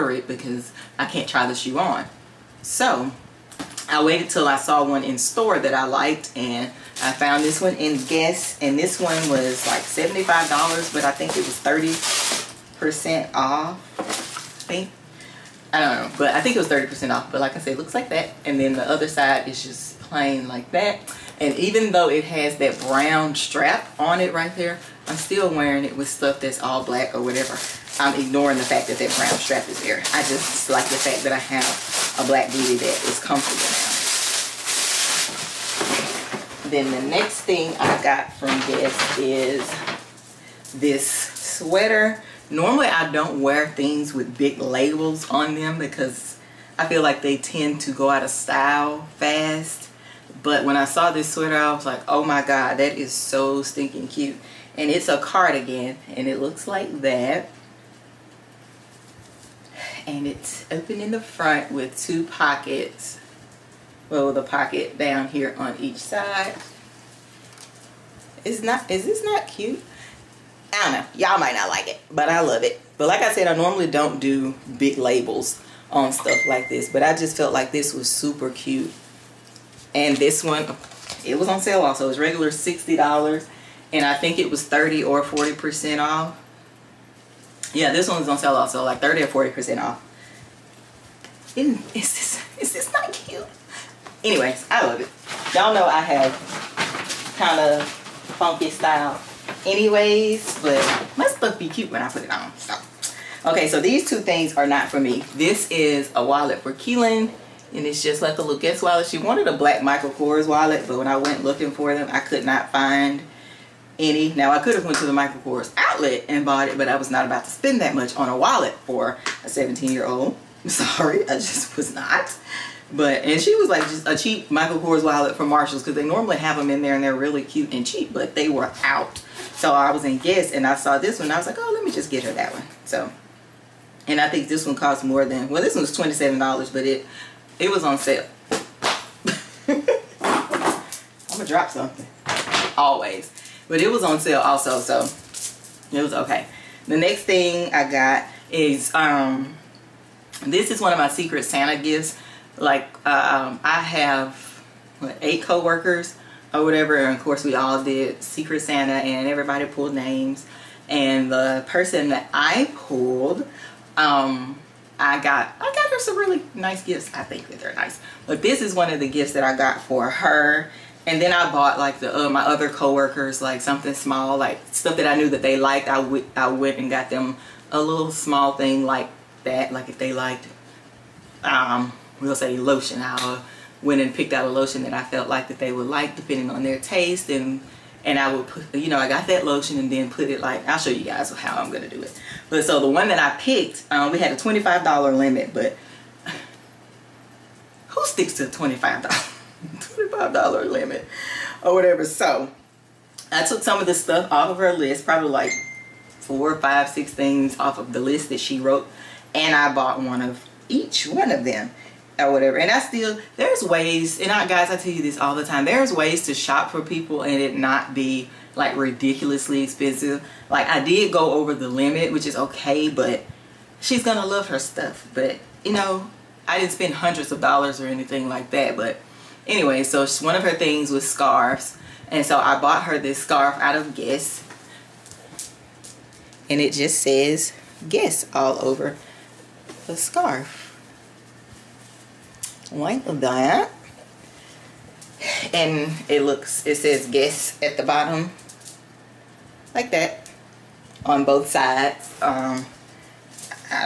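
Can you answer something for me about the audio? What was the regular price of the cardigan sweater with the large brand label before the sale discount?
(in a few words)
$60.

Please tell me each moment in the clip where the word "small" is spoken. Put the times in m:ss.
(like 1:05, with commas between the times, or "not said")
2:53, 2:58.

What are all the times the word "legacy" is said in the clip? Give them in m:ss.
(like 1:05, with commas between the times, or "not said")
not said.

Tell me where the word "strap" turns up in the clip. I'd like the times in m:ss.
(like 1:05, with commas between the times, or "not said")
0:23, 0:29.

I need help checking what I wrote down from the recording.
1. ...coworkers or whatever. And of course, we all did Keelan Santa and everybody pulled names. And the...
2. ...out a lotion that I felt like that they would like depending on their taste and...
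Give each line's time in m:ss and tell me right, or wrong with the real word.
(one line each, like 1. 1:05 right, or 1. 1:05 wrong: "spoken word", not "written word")
1. 2:35 wrong: "Secret", not "Keelan"
2. 3:04 right.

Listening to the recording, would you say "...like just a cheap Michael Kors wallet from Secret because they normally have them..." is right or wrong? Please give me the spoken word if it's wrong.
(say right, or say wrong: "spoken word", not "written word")
wrong: "Marshalls", not "Secret".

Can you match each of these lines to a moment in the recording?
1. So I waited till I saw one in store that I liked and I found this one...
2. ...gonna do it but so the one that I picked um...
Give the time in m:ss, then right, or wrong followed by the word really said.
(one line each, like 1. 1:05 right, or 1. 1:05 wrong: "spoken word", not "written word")
1. 0:02 right
2. 3:11 right.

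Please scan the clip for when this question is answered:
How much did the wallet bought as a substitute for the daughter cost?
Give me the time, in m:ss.
2:15.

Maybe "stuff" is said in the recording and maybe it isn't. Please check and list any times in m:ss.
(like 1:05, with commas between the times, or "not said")
0:26, 1:16, 1:41, 2:54, 3:23, 3:44.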